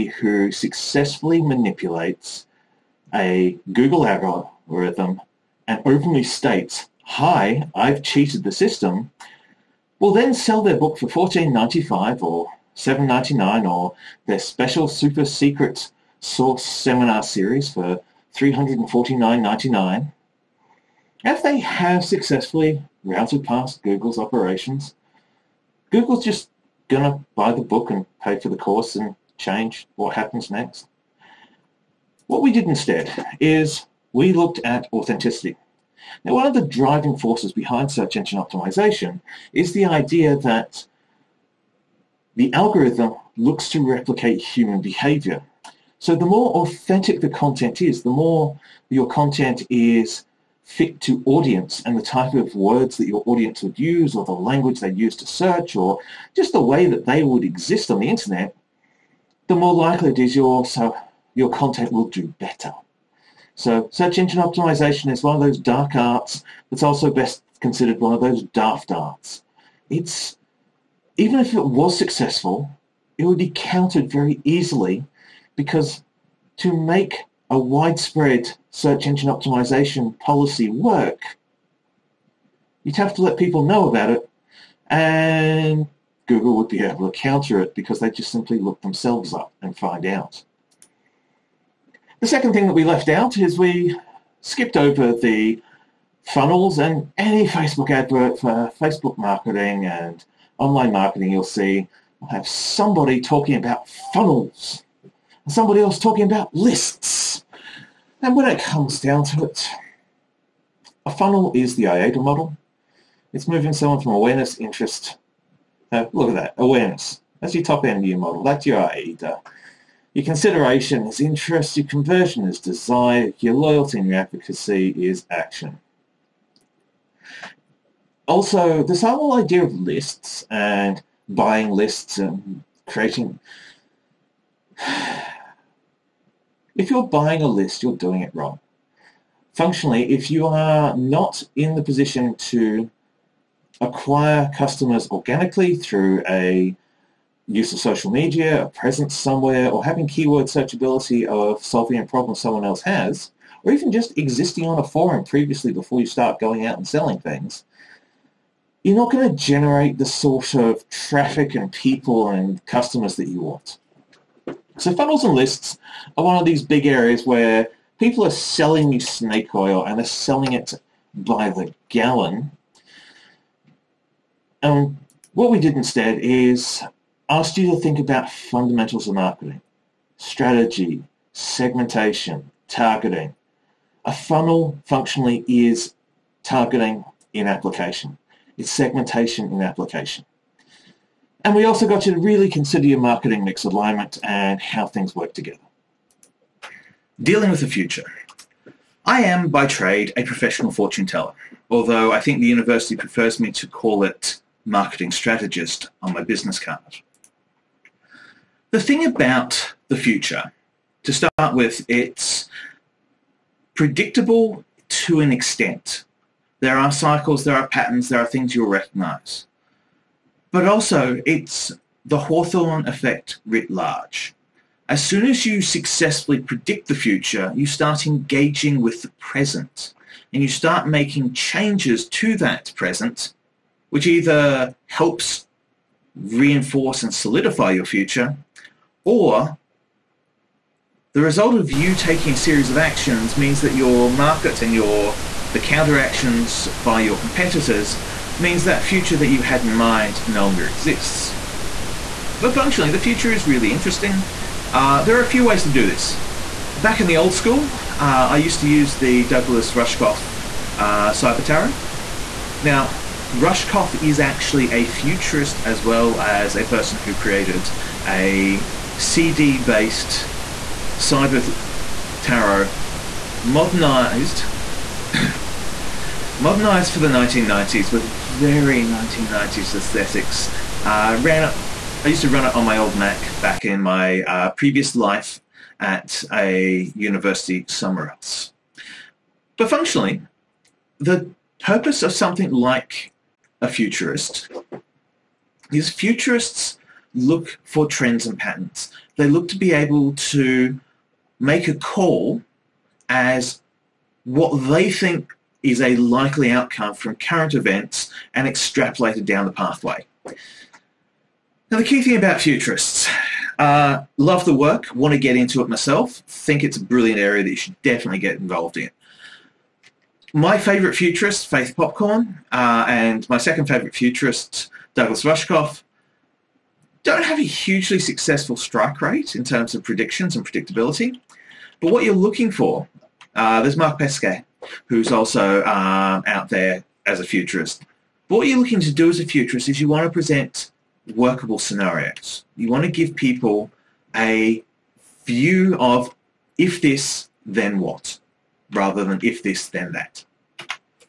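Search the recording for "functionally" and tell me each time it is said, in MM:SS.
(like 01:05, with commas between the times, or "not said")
02:19, 03:04, 04:12, 04:49.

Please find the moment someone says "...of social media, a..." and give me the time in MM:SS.
02:27.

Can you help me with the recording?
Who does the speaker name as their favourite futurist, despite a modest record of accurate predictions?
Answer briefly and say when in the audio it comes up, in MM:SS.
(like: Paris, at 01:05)
Faith Popcorn, at 05:21.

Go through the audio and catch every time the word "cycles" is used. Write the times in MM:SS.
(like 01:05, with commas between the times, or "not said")
03:36.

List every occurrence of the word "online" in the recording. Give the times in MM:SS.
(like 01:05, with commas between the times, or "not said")
01:40.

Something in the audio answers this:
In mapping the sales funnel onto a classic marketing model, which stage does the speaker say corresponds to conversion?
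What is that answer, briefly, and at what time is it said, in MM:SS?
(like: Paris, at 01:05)
Desire, at 02:02.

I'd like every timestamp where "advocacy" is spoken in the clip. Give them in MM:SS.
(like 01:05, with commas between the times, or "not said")
02:04.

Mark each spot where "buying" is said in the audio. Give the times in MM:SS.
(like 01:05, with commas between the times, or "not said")
02:11, 02:17.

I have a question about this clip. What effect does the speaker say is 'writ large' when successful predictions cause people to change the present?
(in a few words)
Hawthorne effect.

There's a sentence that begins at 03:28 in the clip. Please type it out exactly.
The thing about the future, to start with, it's predictable to an extent.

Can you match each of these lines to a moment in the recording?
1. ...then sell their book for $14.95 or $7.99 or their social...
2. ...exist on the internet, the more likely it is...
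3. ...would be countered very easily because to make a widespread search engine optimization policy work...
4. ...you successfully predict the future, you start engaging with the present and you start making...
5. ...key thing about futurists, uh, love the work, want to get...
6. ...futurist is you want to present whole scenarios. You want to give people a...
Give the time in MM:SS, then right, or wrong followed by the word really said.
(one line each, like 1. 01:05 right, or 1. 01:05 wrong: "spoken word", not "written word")
1. 00:10 wrong: "special", not "social"
2. 00:57 right
3. 01:13 right
4. 03:45 right
5. 05:11 right
6. 05:39 wrong: "workable", not "whole".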